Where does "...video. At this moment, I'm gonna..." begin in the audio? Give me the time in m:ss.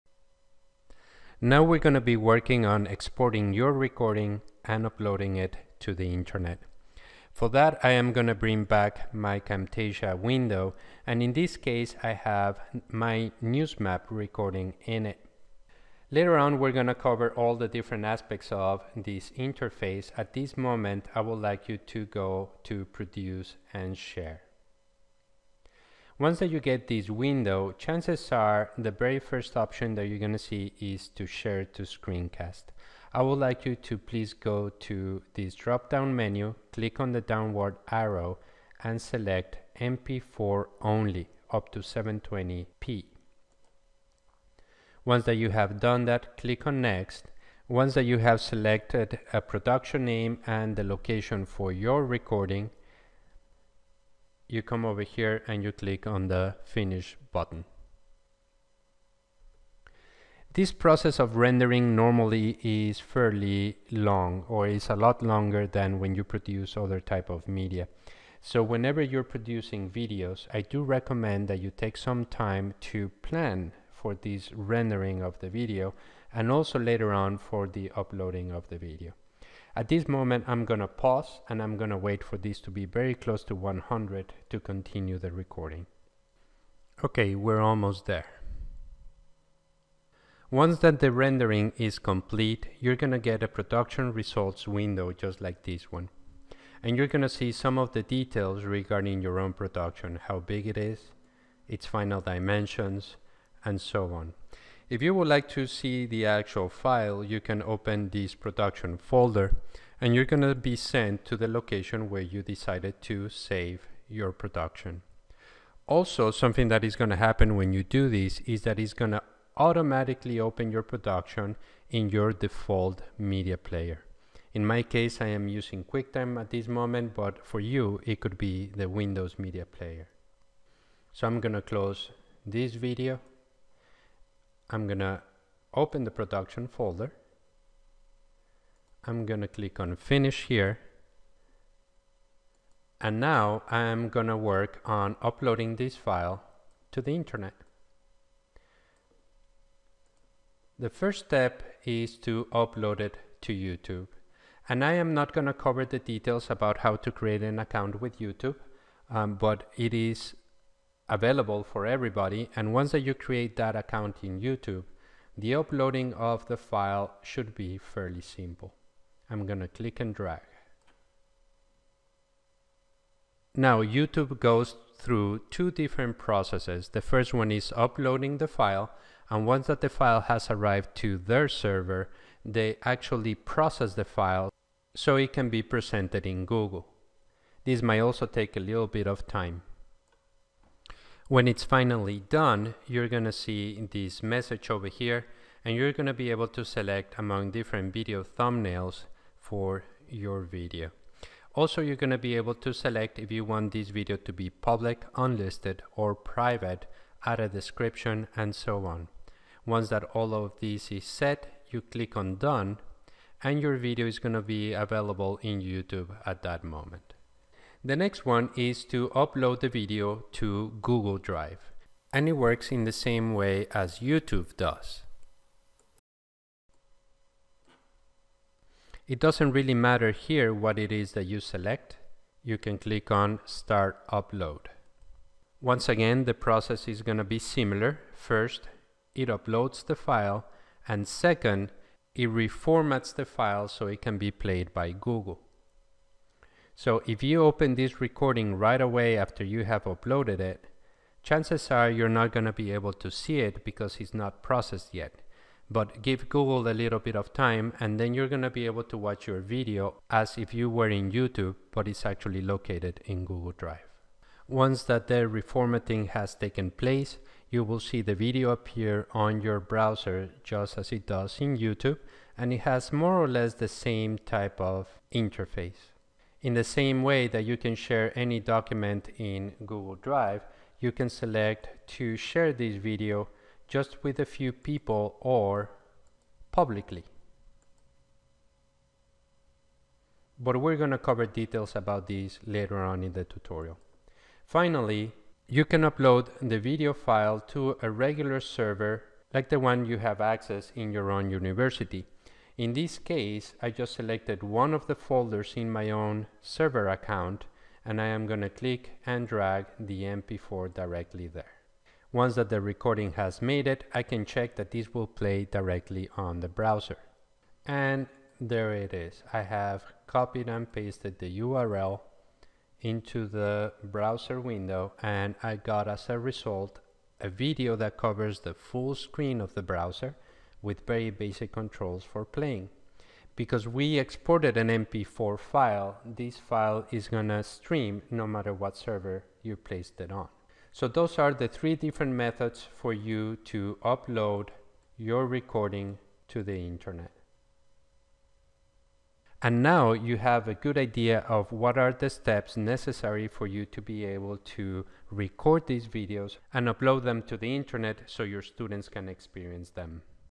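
1:18.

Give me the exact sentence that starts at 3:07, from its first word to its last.
This might also take a little bit of time.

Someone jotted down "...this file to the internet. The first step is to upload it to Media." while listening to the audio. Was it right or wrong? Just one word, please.
wrong.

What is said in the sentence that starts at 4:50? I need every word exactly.
But we're going to cover details about these later on in the tutorial.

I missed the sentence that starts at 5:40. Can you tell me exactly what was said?
So those are the three different methods for you to upload your recording to the internet.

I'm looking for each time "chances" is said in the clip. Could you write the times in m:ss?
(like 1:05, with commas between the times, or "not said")
0:27, 4:11.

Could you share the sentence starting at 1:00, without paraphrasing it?
This process of rendering normally is fairly long or is a lot longer than when you produce other type of media.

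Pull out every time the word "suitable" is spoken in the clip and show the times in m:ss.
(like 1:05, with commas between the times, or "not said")
not said.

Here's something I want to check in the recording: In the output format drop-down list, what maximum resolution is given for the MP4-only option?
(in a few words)
720p.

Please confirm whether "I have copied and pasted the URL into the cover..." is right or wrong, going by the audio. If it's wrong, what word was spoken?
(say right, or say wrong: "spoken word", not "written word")
wrong: "browser", not "cover".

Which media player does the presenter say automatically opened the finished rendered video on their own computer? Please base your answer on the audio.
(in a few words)
QuickTime.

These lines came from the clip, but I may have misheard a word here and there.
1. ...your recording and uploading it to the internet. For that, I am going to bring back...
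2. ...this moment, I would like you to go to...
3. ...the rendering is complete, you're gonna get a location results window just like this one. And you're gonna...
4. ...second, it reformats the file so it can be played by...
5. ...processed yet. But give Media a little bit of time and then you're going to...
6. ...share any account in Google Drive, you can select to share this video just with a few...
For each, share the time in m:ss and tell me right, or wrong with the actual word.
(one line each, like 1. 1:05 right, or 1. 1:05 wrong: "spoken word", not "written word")
1. 0:03 right
2. 0:20 right
3. 1:30 wrong: "production", not "location"
4. 4:01 right
5. 4:14 wrong: "Google", not "Media"
6. 4:37 wrong: "document", not "account".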